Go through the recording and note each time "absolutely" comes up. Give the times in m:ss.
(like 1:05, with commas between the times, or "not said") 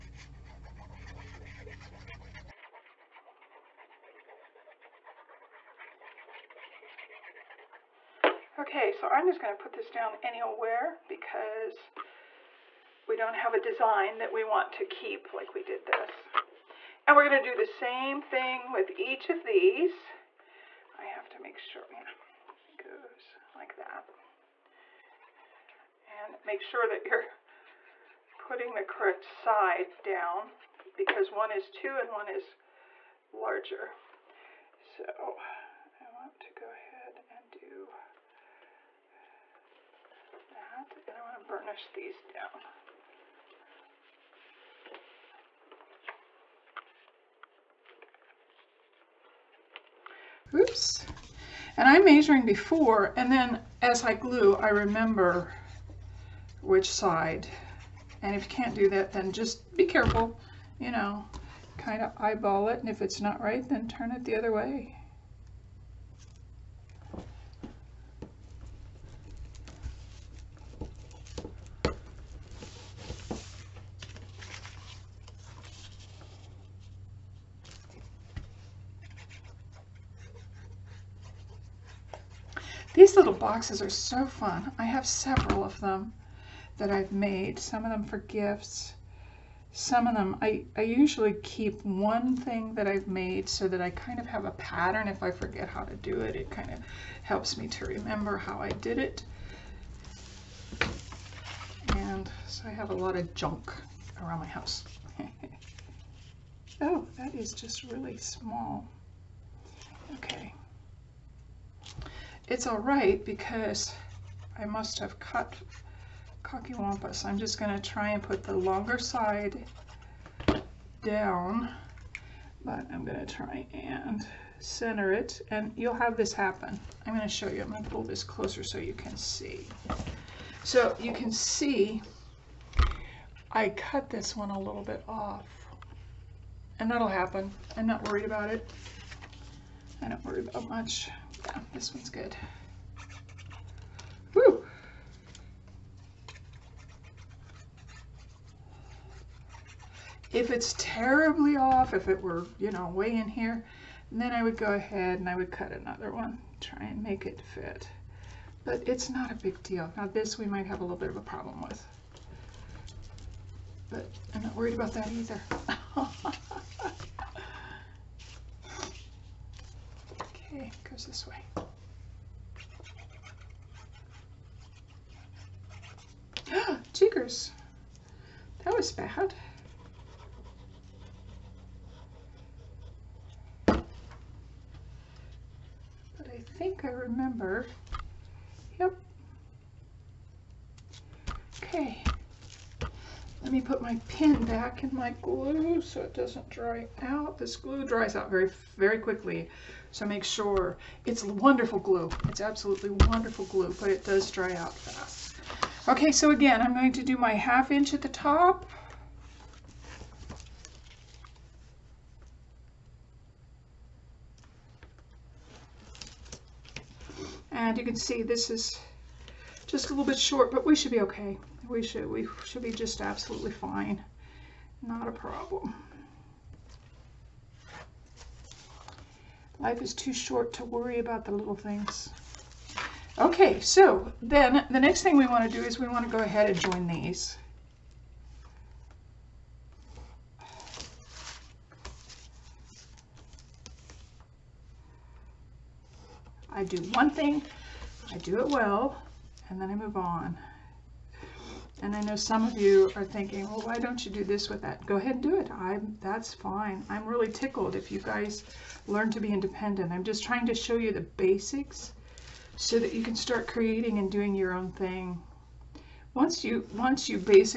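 3:22, 3:43.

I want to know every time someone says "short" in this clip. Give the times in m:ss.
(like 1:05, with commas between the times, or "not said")
3:40, 3:50.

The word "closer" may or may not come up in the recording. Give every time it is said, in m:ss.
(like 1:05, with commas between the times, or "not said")
2:08.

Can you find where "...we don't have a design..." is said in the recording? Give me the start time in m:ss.
0:13.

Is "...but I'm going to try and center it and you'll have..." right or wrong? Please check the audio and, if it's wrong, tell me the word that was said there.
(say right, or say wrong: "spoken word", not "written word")
right.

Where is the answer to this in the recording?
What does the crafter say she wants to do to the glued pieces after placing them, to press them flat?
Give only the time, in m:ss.
0:41.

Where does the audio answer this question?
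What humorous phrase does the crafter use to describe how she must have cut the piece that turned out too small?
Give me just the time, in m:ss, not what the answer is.
1:56.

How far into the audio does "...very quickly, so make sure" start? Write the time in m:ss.
3:18.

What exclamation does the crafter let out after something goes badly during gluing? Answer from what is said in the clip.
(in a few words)
Jiggers.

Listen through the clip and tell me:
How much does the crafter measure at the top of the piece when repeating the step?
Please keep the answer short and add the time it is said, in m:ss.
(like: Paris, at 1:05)
half inch, at 3:27.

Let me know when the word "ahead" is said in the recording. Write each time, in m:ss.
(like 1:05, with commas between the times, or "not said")
0:36, 2:34, 3:56, 4:14.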